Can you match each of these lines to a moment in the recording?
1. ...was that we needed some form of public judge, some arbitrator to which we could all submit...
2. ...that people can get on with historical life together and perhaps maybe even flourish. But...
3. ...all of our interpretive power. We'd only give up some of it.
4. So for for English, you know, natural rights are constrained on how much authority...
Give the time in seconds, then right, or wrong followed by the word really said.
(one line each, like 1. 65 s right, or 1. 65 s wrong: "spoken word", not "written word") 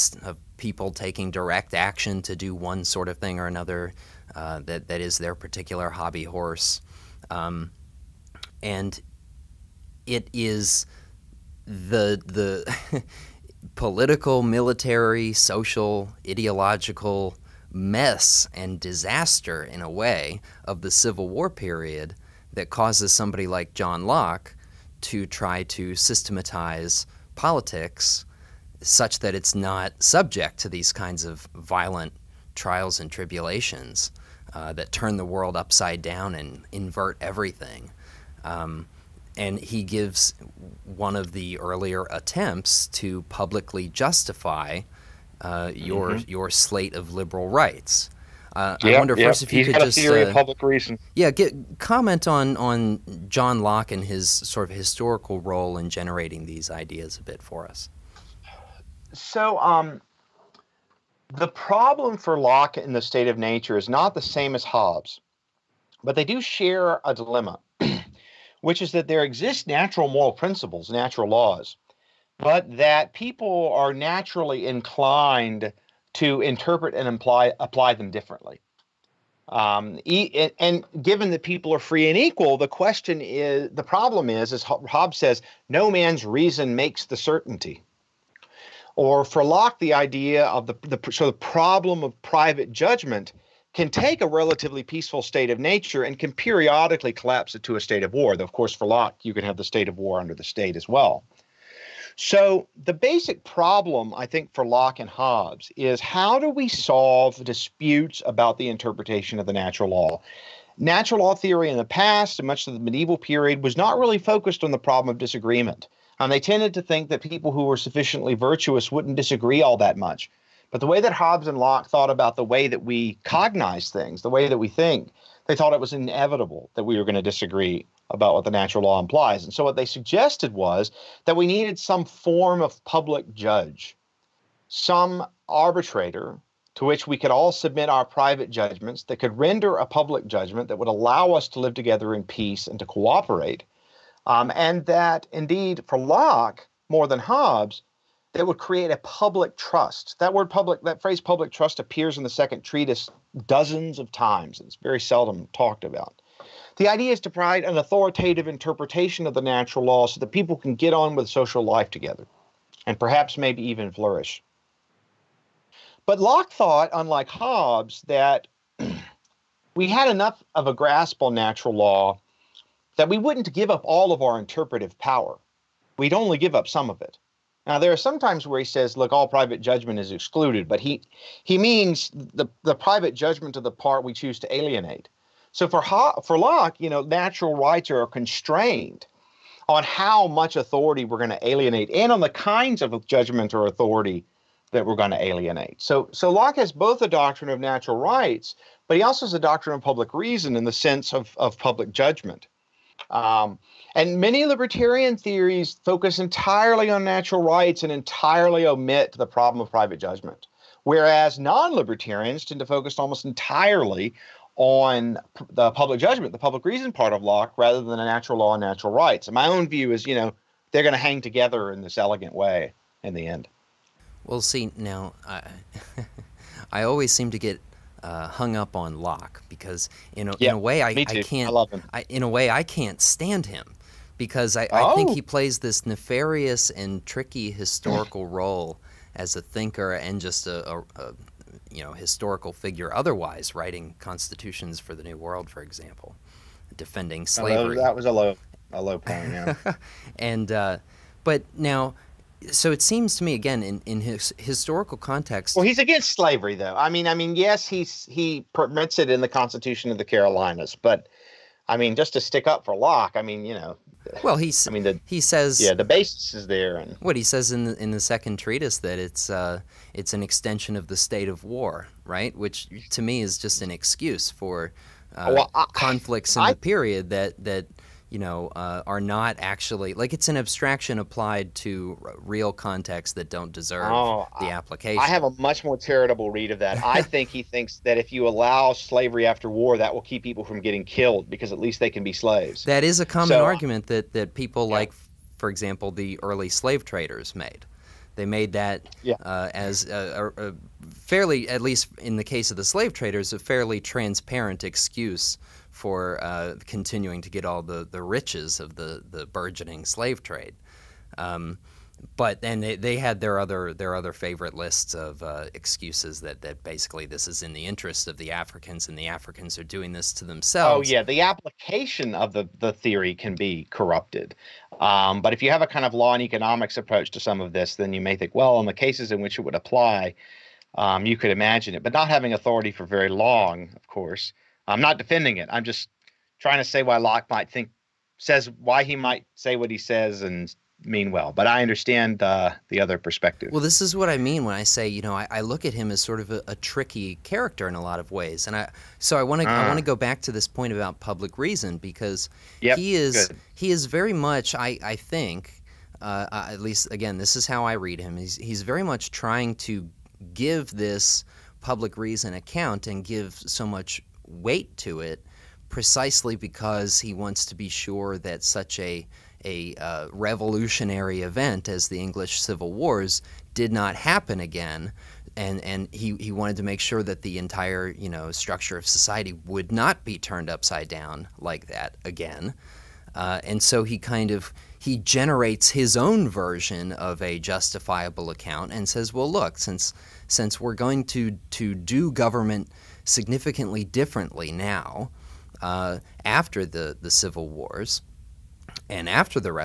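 1. 130 s right
2. 160 s wrong: "social", not "historical"
3. 173 s right
4. 185 s wrong: "Locke", not "English".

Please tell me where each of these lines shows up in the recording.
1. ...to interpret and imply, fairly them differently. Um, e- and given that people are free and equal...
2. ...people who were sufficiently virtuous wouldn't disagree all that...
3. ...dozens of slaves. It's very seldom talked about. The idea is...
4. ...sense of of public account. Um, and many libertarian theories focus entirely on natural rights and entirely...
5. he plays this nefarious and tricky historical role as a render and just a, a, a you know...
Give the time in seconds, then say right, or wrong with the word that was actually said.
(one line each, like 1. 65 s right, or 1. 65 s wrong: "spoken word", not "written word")
1. 76 s wrong: "apply", not "fairly"
2. 117 s right
3. 153 s wrong: "times", not "slaves"
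4. 200 s wrong: "judgment", not "account"
5. 235 s wrong: "thinker", not "render".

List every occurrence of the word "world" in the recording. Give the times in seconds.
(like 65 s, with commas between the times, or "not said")
35 s, 245 s.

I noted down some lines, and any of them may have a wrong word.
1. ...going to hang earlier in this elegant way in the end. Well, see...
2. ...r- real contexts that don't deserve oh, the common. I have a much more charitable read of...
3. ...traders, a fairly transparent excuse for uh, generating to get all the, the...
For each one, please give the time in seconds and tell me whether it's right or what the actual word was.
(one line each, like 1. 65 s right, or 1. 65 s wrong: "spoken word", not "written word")
1. 220 s wrong: "together", not "earlier"
2. 282 s wrong: "application", not "common"
3. 302 s wrong: "continuing", not "generating".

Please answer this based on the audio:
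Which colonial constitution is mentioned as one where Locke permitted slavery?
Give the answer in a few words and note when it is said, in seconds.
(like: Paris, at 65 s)
Constitution of the Carolinas, at 259 s.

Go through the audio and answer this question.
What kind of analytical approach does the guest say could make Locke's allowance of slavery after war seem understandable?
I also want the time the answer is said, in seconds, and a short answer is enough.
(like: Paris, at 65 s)
Law and economics, at 325 s.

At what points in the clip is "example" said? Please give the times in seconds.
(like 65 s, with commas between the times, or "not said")
245 s, 295 s.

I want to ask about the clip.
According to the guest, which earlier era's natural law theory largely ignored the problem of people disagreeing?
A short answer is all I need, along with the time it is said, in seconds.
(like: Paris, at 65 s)
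Medieval period, at 112 s.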